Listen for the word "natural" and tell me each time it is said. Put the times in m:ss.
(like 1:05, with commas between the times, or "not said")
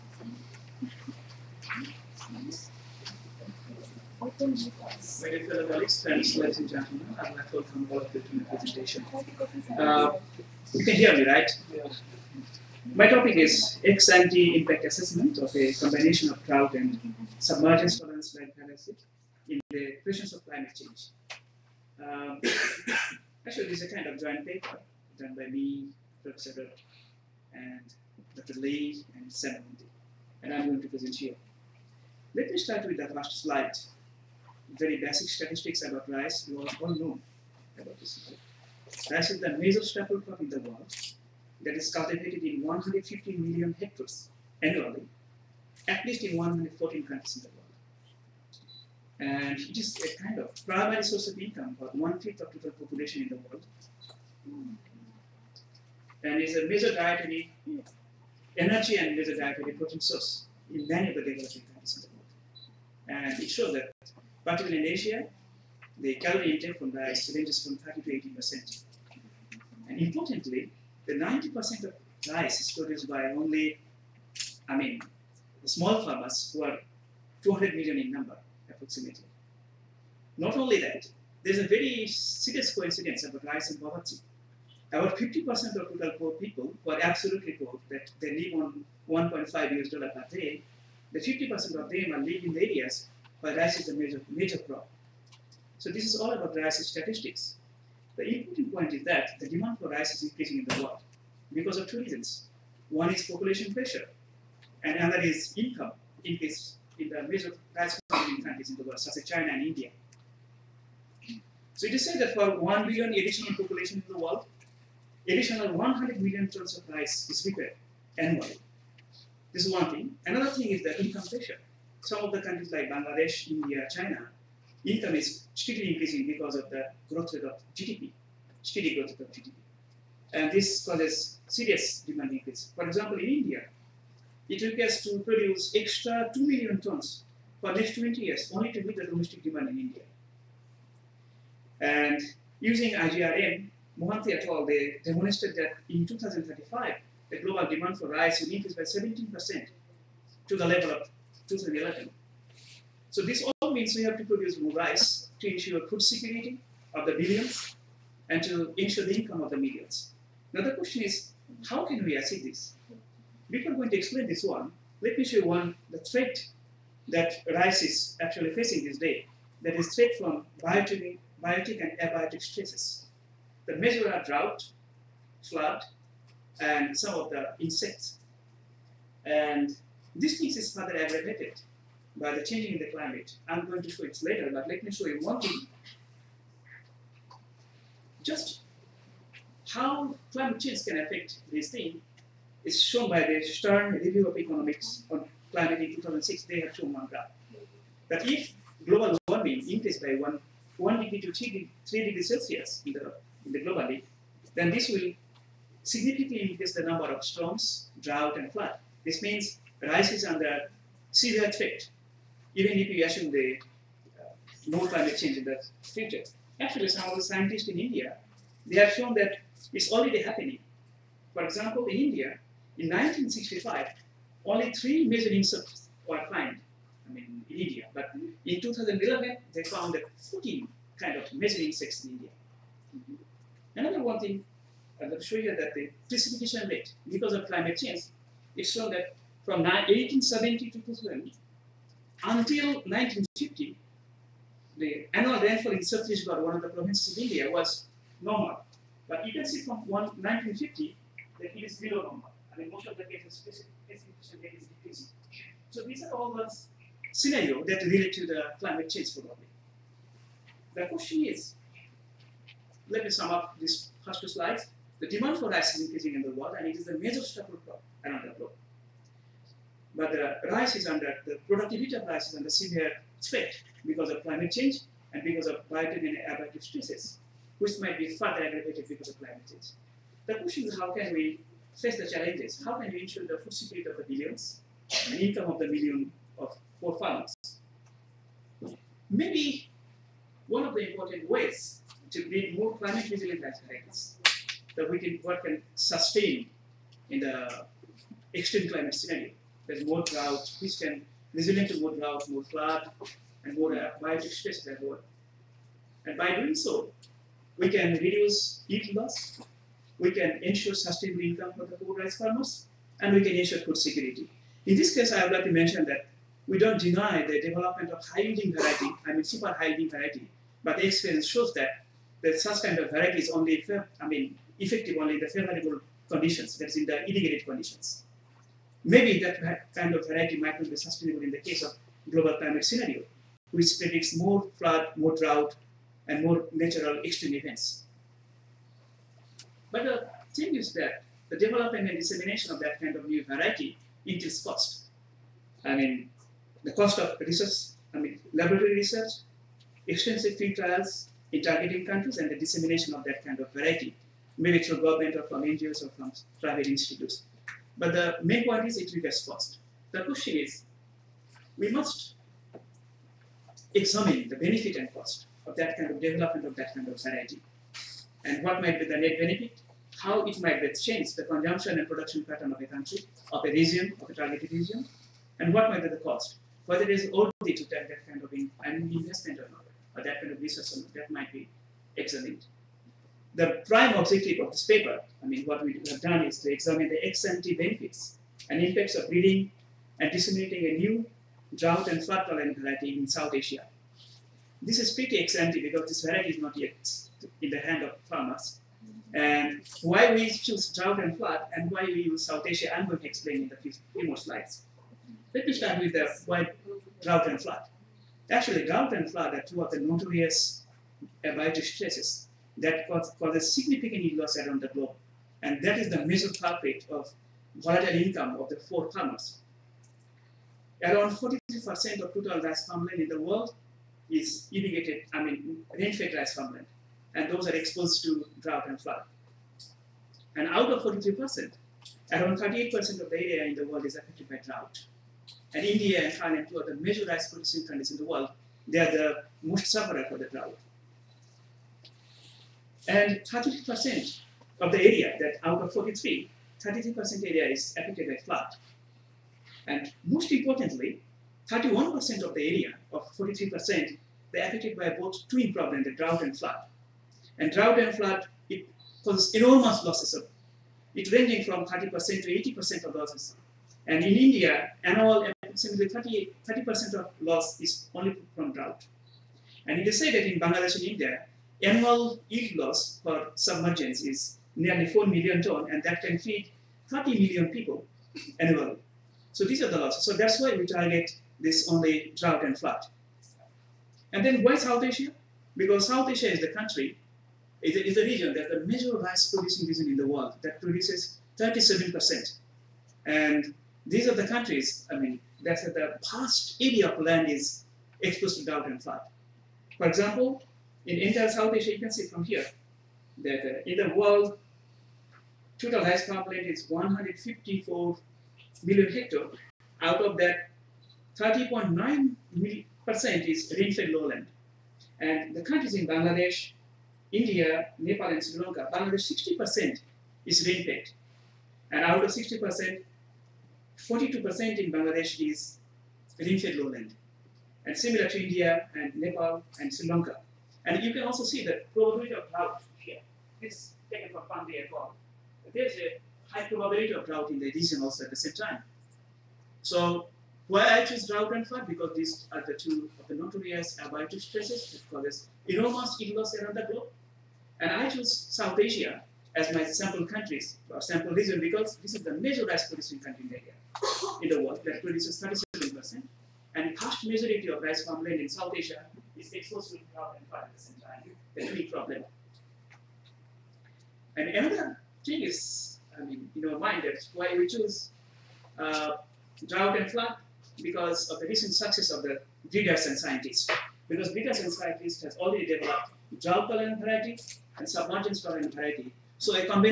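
5:36.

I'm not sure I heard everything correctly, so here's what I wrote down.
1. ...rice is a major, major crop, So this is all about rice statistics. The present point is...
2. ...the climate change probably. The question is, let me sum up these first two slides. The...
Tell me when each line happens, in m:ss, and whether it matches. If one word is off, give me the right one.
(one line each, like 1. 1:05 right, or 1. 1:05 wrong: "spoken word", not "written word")
1. 1:33 wrong: "important", not "present"
2. 4:18 right.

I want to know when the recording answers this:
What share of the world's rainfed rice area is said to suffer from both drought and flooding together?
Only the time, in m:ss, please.
7:31.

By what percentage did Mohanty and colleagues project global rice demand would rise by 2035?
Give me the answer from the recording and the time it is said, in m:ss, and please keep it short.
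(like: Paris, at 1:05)
17%, at 2:28.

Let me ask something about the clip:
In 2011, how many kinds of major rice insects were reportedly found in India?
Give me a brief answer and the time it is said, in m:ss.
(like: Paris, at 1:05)
14, at 3:50.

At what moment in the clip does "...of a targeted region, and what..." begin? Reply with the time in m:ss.
6:14.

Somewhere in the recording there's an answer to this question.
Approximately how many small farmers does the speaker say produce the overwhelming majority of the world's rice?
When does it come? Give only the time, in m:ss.
1:17.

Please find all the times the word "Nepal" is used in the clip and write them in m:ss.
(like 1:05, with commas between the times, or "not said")
8:37, 8:48.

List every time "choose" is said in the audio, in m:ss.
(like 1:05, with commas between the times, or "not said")
6:40, 9:00, 9:07, 9:27.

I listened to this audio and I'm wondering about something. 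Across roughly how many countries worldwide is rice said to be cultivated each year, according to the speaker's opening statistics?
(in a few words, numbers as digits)
114.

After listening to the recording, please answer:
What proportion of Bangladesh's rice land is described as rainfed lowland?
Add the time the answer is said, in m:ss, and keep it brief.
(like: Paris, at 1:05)
42%, at 8:43.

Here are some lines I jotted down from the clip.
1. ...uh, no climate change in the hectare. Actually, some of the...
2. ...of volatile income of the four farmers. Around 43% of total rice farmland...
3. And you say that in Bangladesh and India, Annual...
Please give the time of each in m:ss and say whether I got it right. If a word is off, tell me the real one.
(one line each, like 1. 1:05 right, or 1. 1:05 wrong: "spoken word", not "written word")
1. 3:34 wrong: "future", not "hectare"
2. 6:56 right
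3. 7:49 right.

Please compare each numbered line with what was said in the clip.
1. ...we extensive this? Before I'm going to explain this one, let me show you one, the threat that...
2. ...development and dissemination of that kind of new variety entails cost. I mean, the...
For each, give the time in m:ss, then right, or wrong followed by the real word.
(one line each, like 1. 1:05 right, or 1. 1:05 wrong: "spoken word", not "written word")
1. 2:42 wrong: "achieve", not "extensive"
2. 5:41 right.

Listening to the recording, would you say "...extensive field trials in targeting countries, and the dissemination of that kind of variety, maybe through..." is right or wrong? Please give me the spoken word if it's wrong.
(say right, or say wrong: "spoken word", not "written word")
right.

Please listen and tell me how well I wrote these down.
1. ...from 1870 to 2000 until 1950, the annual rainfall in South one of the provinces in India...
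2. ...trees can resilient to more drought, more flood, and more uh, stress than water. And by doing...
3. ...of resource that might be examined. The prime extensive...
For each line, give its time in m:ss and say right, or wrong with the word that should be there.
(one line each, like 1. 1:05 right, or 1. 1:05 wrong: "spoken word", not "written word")
1. 3:59 right
2. 5:00 right
3. 6:20 wrong: "objective", not "extensive".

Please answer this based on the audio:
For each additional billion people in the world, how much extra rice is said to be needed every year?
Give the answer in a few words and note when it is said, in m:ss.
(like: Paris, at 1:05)
100 million tons, at 1:55.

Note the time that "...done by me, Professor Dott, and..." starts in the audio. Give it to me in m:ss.
0:25.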